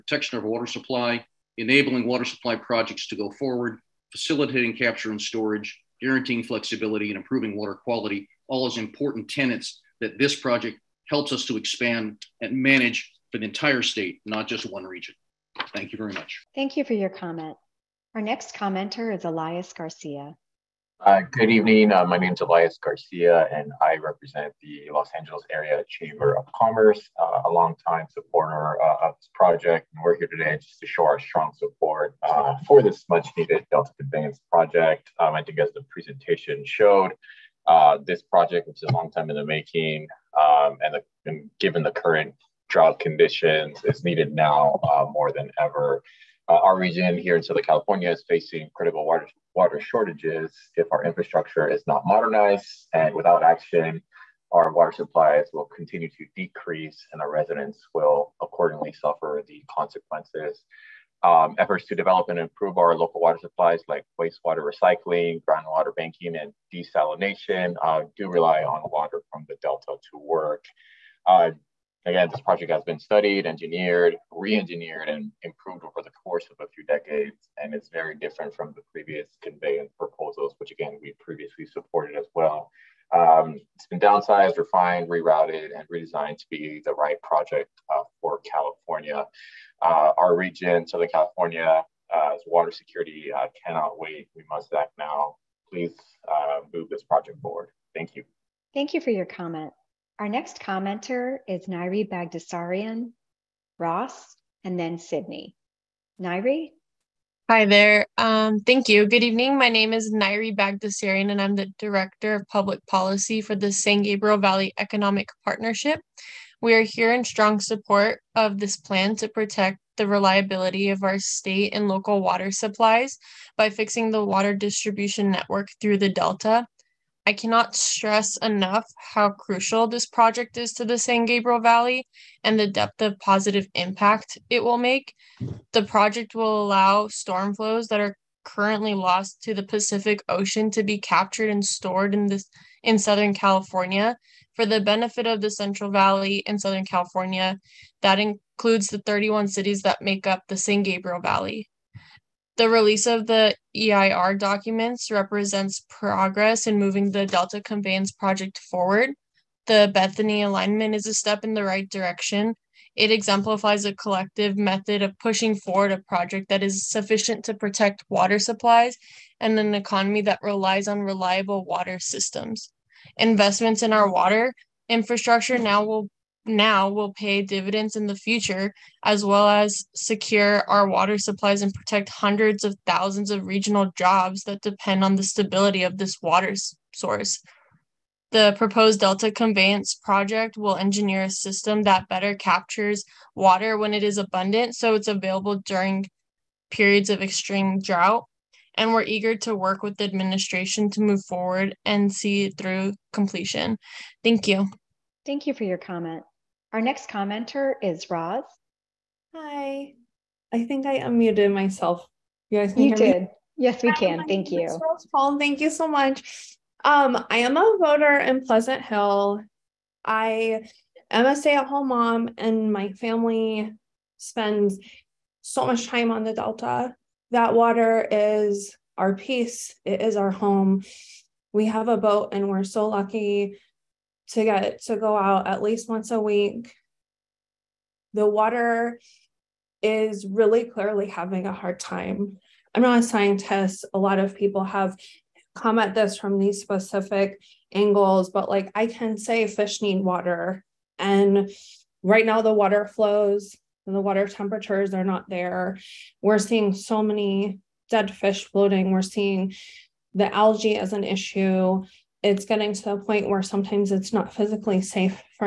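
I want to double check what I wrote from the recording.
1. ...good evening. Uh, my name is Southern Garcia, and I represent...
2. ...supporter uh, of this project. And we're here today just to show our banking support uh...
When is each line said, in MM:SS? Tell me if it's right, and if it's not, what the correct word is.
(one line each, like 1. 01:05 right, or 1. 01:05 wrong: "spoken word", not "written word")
1. 00:21 wrong: "Elias", not "Southern"
2. 00:28 wrong: "strong", not "banking".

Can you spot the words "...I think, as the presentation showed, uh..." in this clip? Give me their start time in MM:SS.
00:35.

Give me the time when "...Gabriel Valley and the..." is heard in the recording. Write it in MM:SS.
02:11.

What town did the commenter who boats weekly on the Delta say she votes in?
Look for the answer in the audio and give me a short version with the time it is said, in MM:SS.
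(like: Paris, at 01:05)
Pleasant Hill, at 03:38.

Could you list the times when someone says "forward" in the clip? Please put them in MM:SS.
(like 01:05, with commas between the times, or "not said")
00:03, 01:37, 02:38, 02:45, 03:21.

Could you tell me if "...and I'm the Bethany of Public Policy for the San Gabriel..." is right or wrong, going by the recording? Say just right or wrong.
wrong.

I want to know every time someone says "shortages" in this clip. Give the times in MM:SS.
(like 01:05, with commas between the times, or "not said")
00:49.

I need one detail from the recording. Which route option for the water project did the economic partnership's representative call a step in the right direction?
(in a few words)
Bethany alignment.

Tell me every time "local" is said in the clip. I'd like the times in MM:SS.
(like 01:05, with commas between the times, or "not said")
01:02, 02:01.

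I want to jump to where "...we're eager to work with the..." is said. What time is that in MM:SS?
03:18.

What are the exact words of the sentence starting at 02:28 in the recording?
That includes the 31 cities that make up the San Gabriel Valley.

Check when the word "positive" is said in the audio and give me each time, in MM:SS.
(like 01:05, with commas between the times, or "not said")
02:13.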